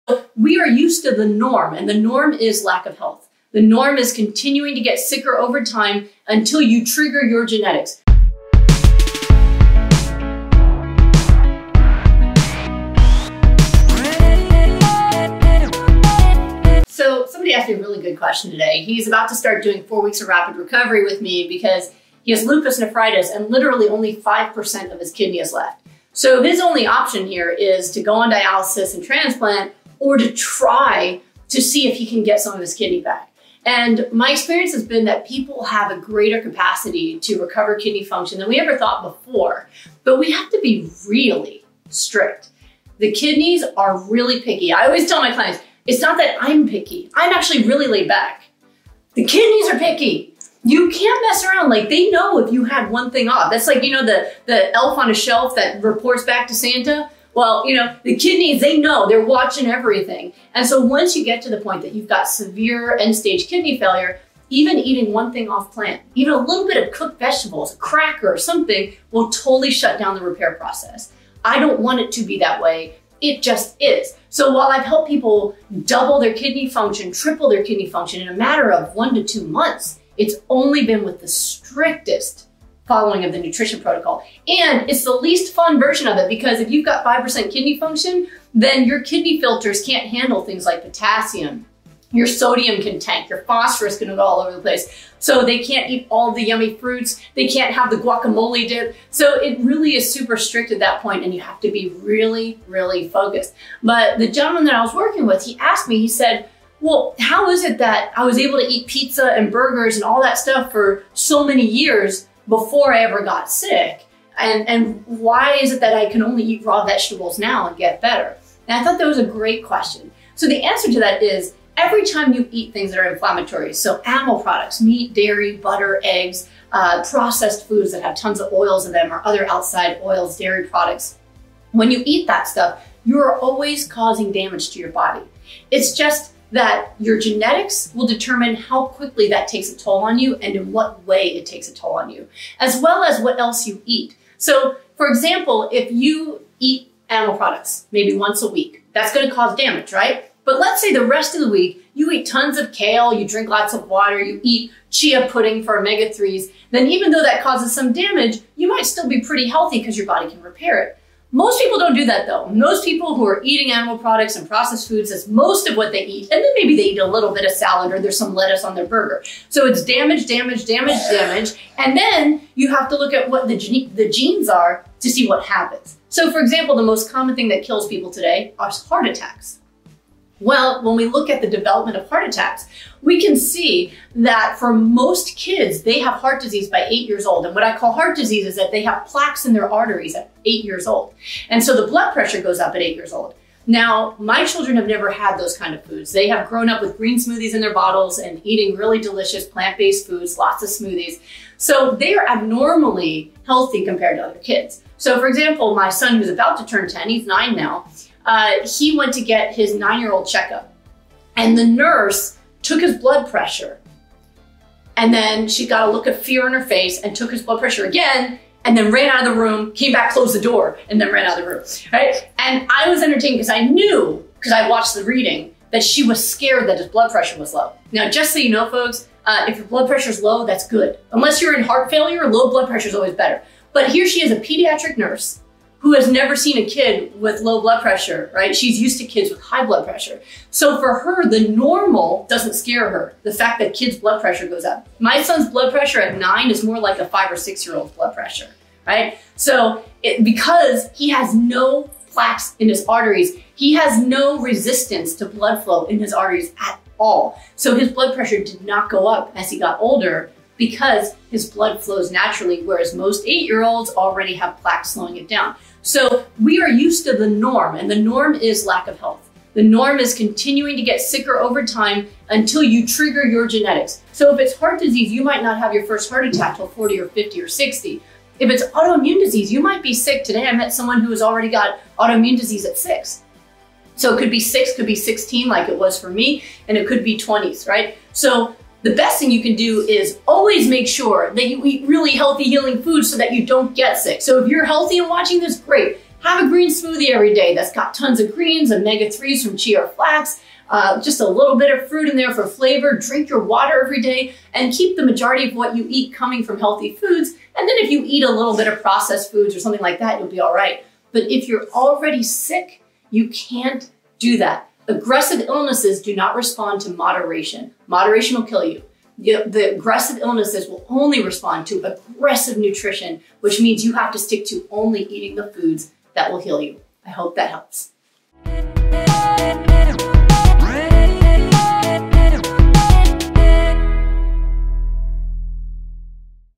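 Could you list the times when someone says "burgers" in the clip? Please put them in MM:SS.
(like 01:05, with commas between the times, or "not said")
01:49, 02:48.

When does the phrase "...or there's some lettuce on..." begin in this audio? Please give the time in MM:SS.
02:47.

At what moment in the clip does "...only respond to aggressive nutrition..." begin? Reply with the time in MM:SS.
05:20.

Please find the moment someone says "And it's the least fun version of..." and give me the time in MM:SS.
01:24.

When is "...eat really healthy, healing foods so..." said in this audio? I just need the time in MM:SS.
04:51.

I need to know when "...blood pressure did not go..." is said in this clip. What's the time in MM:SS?
04:17.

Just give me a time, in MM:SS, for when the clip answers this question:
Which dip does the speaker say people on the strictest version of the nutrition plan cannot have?
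01:37.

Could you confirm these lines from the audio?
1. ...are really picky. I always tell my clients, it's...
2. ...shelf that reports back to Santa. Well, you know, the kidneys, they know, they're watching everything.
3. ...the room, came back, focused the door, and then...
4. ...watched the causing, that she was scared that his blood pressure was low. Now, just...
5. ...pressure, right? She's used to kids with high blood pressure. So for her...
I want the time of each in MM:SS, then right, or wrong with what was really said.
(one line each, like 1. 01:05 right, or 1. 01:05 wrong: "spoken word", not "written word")
1. 00:43 right
2. 00:55 right
3. 03:39 wrong: "closed", not "focused"
4. 03:44 wrong: "reading", not "causing"
5. 03:57 right.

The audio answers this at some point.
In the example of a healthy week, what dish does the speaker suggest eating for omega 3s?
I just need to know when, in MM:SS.
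02:34.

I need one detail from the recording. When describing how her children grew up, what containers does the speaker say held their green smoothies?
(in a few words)
bottles.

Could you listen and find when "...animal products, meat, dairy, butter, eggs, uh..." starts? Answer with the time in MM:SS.
02:04.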